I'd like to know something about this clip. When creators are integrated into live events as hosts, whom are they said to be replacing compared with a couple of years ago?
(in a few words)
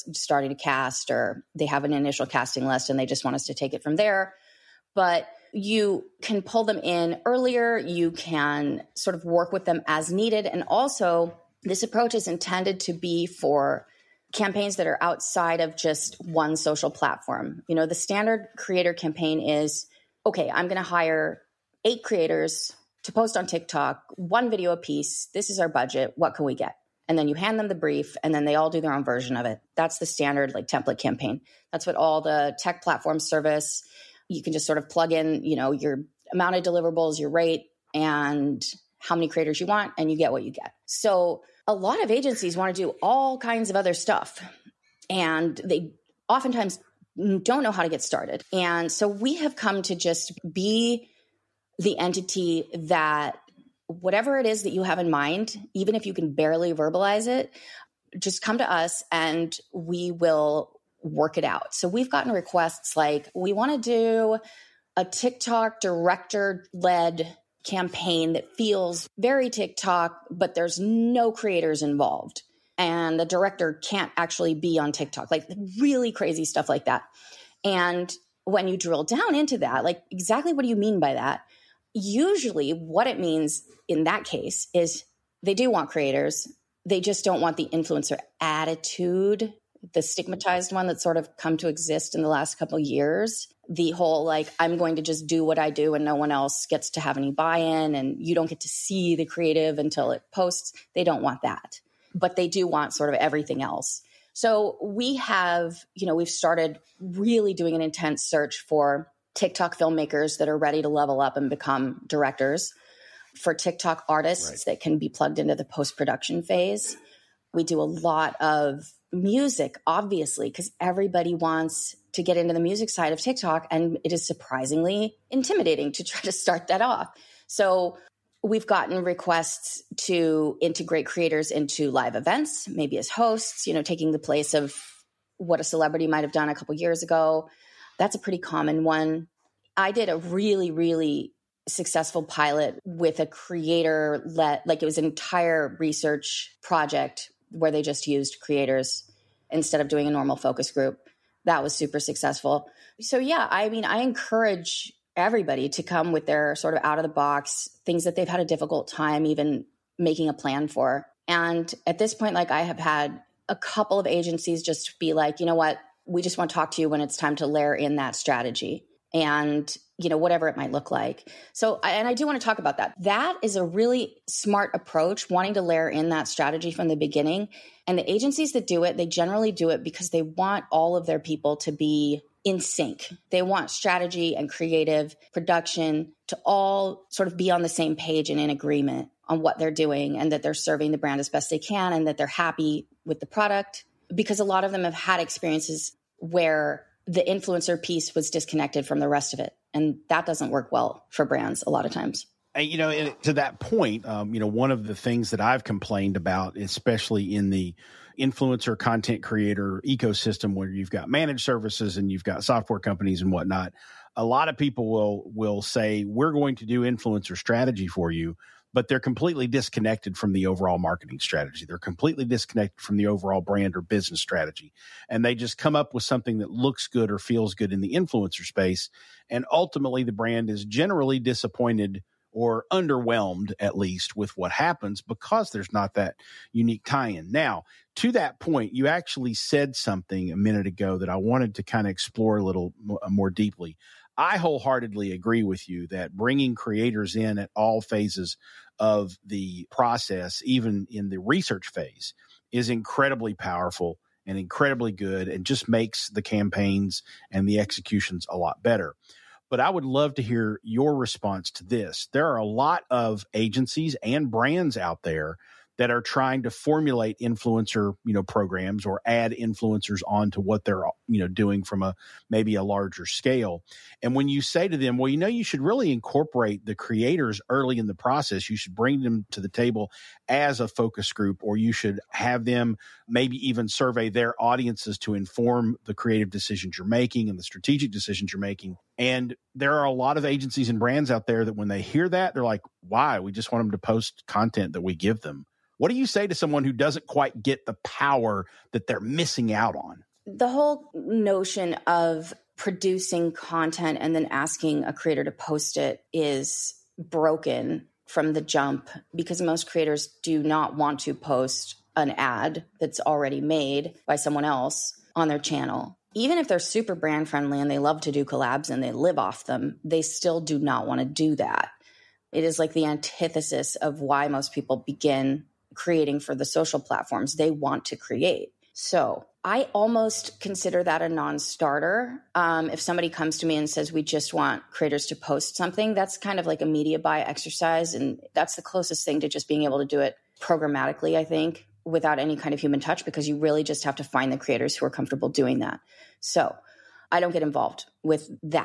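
a celebrity.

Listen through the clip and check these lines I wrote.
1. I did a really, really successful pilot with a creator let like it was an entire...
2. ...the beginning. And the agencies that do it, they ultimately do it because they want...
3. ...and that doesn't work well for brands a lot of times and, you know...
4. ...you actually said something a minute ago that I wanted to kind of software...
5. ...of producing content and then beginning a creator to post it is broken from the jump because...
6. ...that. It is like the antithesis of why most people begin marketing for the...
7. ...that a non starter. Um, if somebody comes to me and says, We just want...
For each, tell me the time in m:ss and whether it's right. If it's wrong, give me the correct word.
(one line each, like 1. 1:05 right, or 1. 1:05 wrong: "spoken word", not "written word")
1. 2:19 right
2. 2:56 wrong: "generally", not "ultimately"
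3. 3:19 right
4. 3:58 wrong: "explore", not "software"
5. 5:01 wrong: "asking", not "beginning"
6. 5:21 wrong: "creating", not "marketing"
7. 5:30 right.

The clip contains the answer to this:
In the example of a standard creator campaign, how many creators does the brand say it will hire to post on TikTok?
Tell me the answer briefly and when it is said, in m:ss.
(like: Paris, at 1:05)
8, at 0:21.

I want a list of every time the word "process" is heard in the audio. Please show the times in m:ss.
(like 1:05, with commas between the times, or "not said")
4:09, 4:37.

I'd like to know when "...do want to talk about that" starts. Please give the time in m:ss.
2:52.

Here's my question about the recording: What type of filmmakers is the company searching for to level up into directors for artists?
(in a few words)
TikTok filmmakers.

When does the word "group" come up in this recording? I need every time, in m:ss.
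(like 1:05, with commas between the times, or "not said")
2:30, 4:41.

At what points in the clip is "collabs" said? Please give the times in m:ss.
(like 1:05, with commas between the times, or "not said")
5:18.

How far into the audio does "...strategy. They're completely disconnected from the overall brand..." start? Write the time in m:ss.
3:41.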